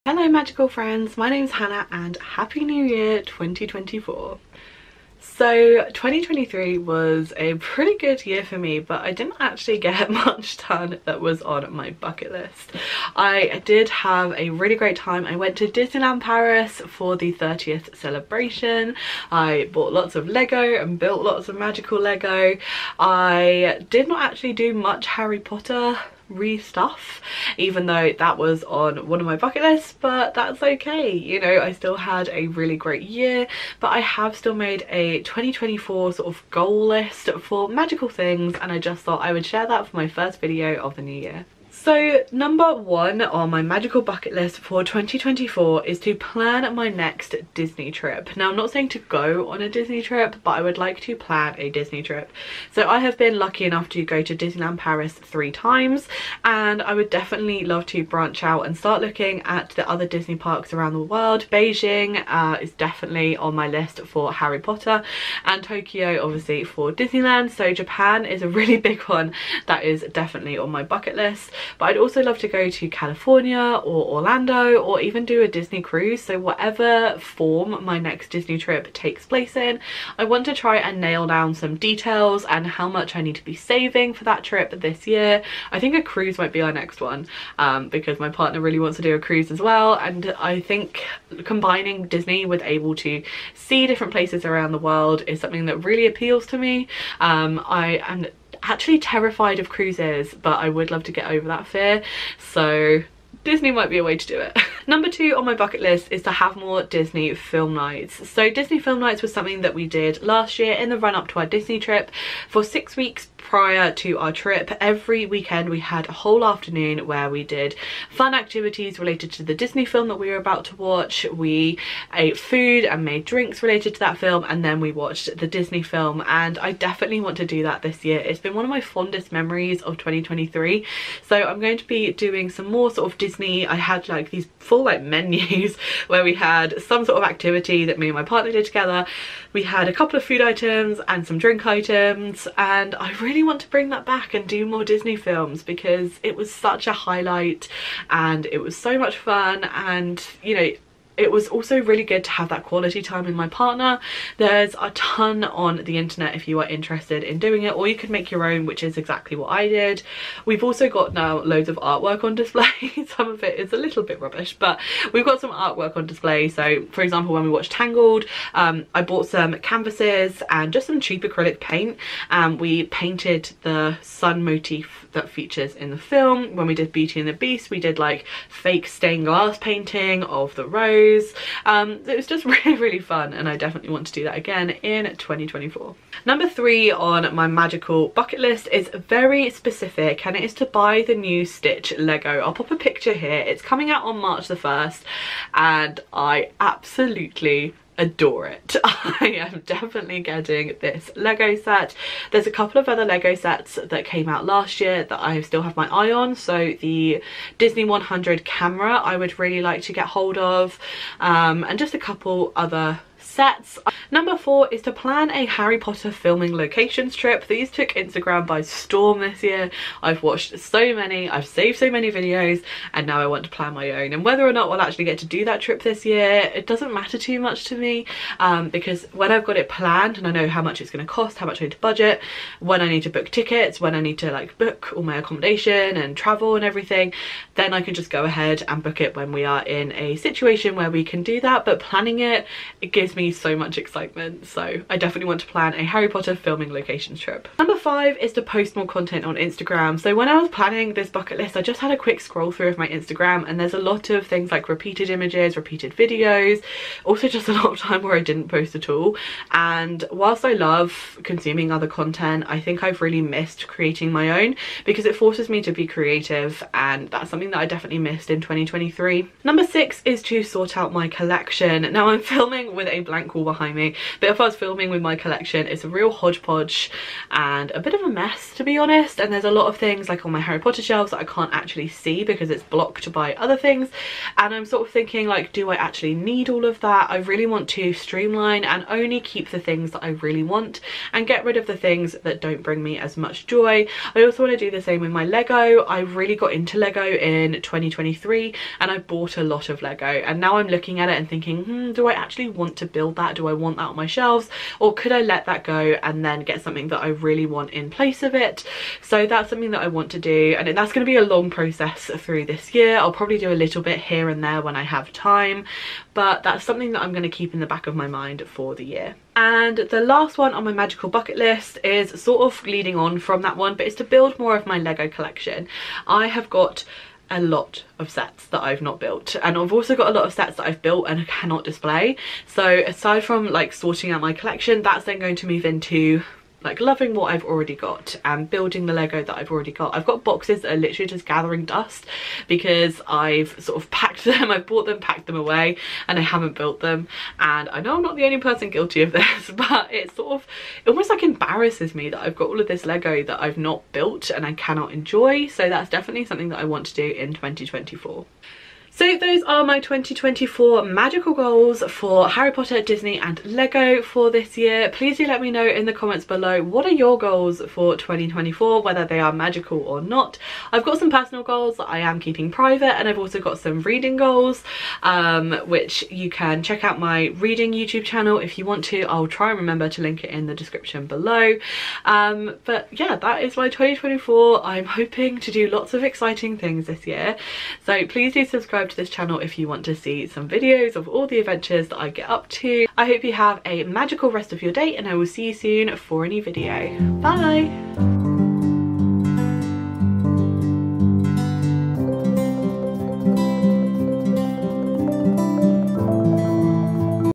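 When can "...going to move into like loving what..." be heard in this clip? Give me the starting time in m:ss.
5:35.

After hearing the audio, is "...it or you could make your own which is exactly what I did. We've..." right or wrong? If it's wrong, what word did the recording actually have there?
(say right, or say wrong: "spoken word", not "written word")
right.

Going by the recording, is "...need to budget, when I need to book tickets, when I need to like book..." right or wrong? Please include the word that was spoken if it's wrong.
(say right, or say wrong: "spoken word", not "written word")
right.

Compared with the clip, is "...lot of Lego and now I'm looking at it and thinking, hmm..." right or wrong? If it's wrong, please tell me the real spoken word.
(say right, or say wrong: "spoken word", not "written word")
right.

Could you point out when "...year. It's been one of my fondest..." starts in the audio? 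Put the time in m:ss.
2:08.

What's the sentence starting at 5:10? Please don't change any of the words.
And that's going to be a long process through this year.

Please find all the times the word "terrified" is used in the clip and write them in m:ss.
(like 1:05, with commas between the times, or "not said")
1:38.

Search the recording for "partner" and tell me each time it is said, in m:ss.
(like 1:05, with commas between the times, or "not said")
1:28, 2:18, 2:33.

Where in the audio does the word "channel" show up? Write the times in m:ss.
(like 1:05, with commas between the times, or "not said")
6:18, 6:29.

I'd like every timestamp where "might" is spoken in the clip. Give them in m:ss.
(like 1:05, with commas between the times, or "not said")
1:26, 1:43.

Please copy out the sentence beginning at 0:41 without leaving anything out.
So number one on my magical bucket list for 2024 is to plan my next Disney trip.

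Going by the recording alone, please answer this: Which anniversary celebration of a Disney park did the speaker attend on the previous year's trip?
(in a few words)
30th.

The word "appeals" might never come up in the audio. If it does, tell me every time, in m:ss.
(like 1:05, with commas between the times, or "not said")
1:36.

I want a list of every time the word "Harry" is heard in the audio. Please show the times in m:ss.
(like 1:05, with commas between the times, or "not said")
0:25, 1:04, 3:35, 4:05, 4:40, 6:02.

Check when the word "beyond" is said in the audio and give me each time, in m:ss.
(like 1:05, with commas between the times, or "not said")
not said.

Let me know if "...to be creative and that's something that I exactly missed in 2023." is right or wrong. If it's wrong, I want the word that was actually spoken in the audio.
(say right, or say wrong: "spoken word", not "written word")
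wrong: "definitely", not "exactly".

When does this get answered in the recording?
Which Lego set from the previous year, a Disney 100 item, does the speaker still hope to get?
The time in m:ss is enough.
3:27.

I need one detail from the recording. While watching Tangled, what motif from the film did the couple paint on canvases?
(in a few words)
The sun.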